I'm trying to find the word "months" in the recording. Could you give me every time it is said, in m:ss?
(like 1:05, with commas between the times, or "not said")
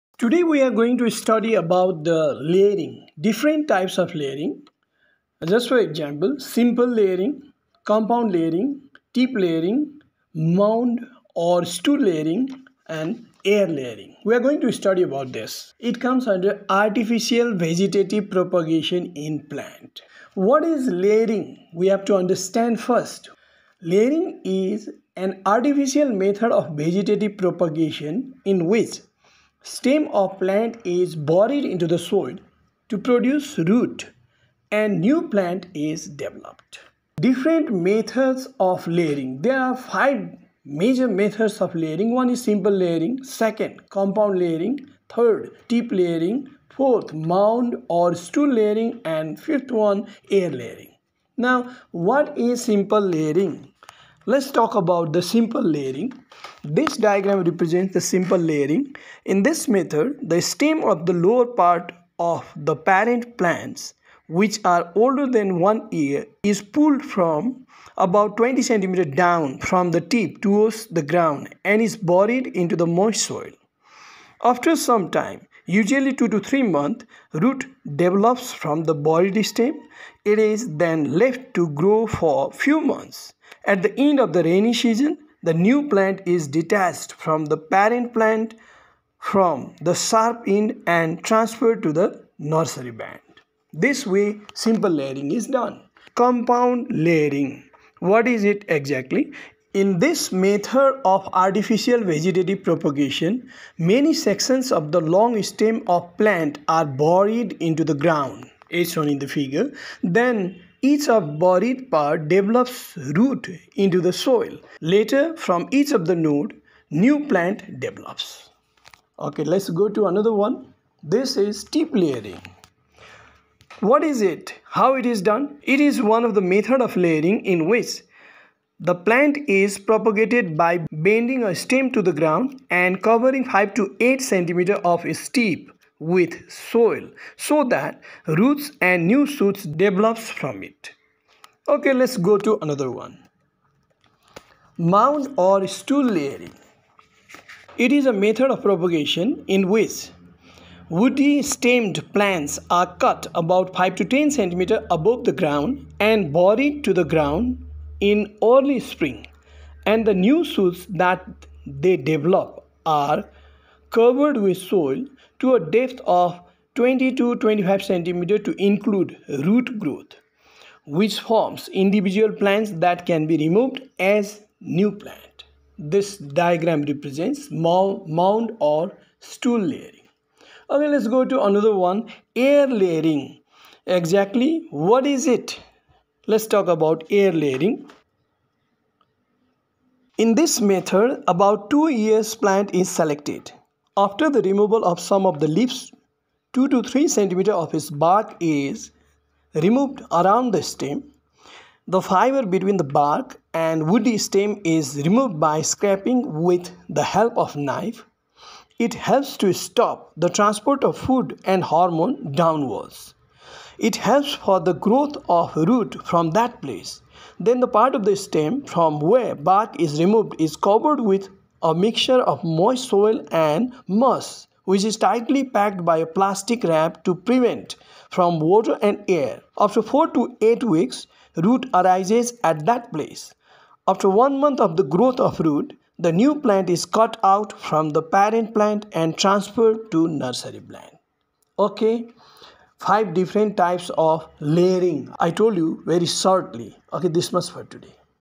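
1:16, 1:22, 3:54.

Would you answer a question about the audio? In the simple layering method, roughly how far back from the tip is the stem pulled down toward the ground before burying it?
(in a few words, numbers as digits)
20 centimeters.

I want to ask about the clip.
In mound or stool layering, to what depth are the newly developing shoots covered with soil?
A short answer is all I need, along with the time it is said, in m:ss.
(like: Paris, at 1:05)
20 to 25 centimeters, at 2:46.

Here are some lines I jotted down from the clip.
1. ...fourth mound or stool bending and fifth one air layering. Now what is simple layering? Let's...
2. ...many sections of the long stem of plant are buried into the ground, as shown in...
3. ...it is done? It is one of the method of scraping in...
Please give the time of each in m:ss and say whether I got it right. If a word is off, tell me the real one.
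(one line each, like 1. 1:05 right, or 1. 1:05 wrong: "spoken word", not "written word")
1. 0:46 wrong: "layering", not "bending"
2. 1:43 right
3. 2:04 wrong: "layering", not "scraping".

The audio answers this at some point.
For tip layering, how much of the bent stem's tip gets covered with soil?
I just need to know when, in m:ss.
2:13.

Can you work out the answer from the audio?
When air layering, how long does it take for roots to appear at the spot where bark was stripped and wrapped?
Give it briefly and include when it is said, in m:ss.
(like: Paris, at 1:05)
4 to 8 weeks, at 3:49.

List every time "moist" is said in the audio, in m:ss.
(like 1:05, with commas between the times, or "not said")
1:12, 3:42.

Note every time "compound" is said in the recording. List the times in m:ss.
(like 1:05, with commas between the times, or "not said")
0:07, 0:43, 1:36.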